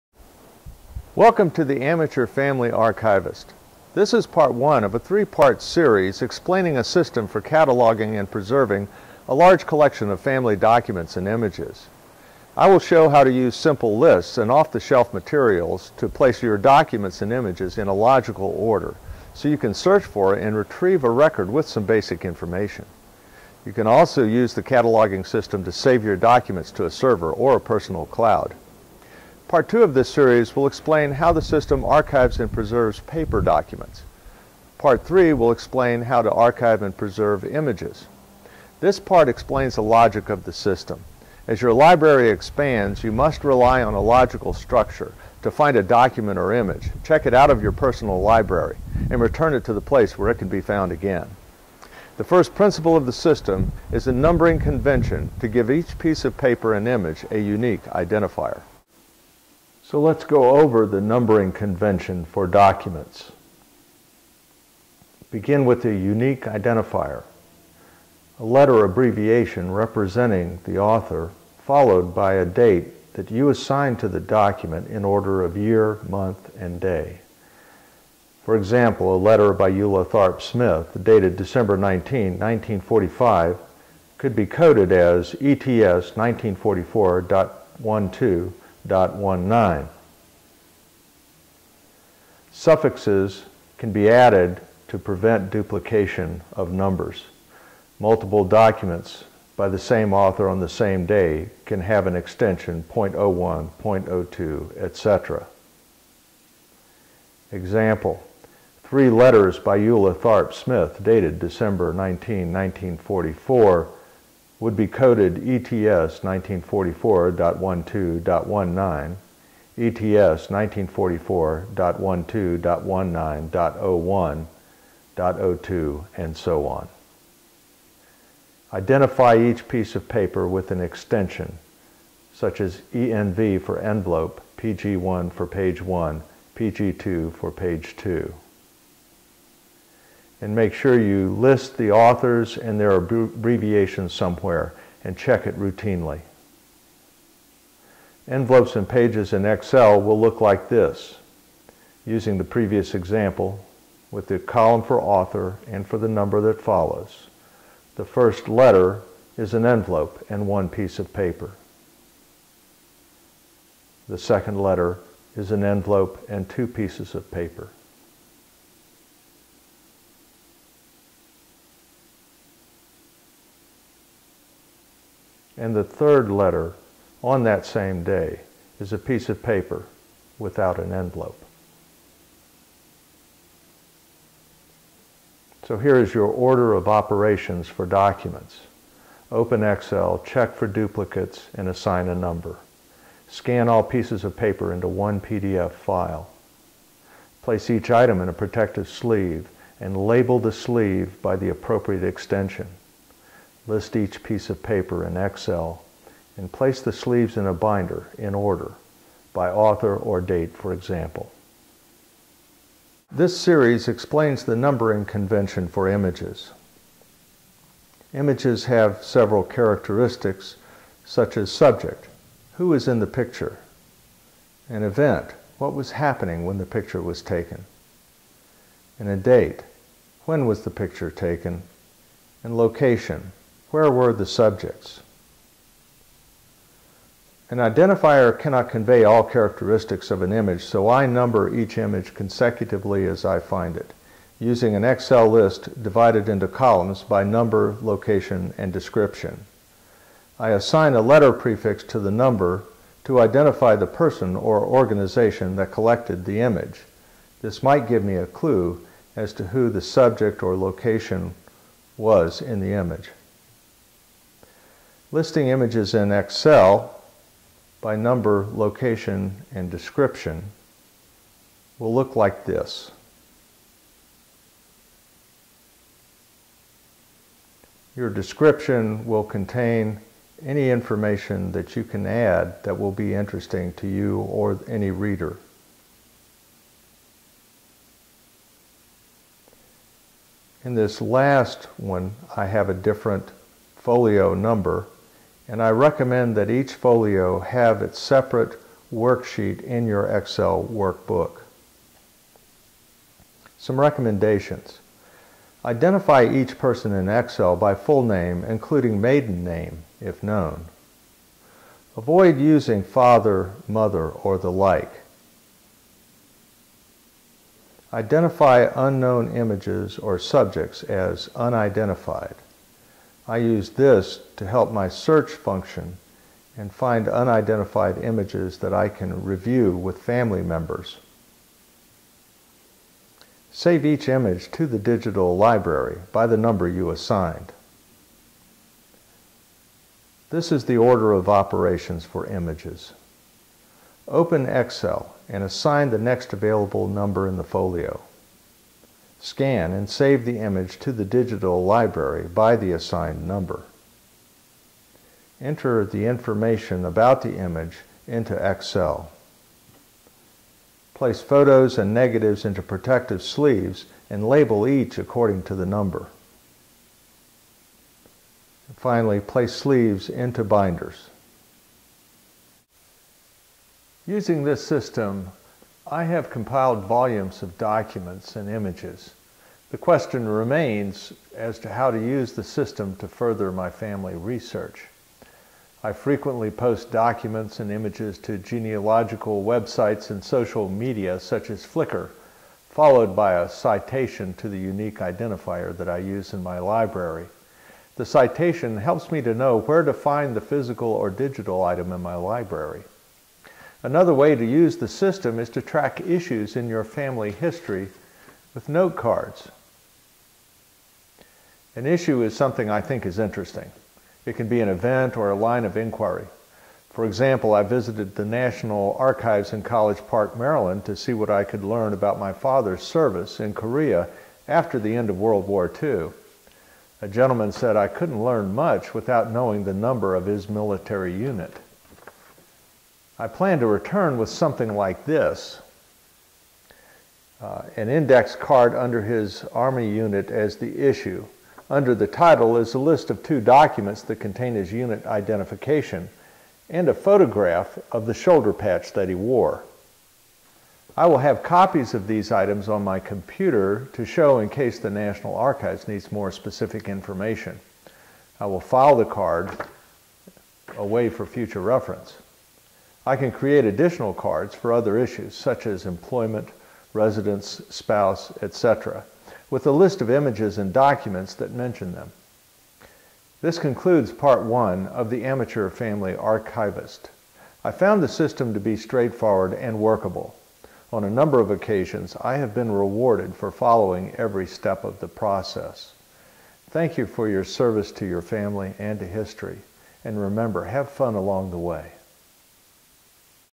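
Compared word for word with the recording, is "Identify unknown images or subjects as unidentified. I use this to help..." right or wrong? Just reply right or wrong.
right.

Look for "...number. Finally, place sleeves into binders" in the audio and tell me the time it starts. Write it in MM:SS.
06:05.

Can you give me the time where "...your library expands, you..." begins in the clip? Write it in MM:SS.
00:41.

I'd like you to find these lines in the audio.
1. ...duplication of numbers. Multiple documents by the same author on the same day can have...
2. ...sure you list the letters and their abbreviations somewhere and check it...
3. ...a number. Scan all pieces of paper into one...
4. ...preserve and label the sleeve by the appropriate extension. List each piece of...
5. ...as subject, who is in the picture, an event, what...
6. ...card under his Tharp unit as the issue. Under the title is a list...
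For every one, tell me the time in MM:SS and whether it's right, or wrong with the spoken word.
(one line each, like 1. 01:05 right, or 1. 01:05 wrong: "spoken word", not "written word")
1. 01:35 right
2. 02:20 wrong: "authors", not "letters"
3. 03:12 right
4. 03:18 wrong: "sleeve", not "preserve"
5. 03:41 right
6. 07:18 wrong: "Army", not "Tharp".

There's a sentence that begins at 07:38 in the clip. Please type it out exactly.
I will file the card away for future reference.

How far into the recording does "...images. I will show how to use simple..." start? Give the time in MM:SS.
00:11.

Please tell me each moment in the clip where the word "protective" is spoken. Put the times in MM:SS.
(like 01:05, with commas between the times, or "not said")
03:18, 06:02.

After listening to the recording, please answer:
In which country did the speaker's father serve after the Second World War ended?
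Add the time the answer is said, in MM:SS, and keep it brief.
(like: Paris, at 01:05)
Korea, at 07:03.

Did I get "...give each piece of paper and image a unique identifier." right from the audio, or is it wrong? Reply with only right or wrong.
right.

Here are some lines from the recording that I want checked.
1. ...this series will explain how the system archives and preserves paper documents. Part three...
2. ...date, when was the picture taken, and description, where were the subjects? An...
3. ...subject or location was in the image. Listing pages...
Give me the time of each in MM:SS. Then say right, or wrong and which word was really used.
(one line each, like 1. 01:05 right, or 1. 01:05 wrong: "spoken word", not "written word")
1. 00:29 right
2. 03:49 wrong: "location", not "description"
3. 04:19 wrong: "images", not "pages".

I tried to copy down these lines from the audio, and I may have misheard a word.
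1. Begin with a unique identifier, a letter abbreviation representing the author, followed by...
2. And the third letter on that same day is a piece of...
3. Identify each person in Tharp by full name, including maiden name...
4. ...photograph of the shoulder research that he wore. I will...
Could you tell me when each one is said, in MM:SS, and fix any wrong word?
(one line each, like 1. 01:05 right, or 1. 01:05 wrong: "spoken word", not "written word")
1. 01:05 right
2. 02:55 right
3. 05:05 wrong: "Excel", not "Tharp"
4. 07:26 wrong: "patch", not "research".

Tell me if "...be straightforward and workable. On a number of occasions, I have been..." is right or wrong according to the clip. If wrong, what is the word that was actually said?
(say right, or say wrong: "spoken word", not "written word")
right.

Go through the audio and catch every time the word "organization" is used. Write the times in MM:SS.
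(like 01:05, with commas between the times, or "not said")
04:14.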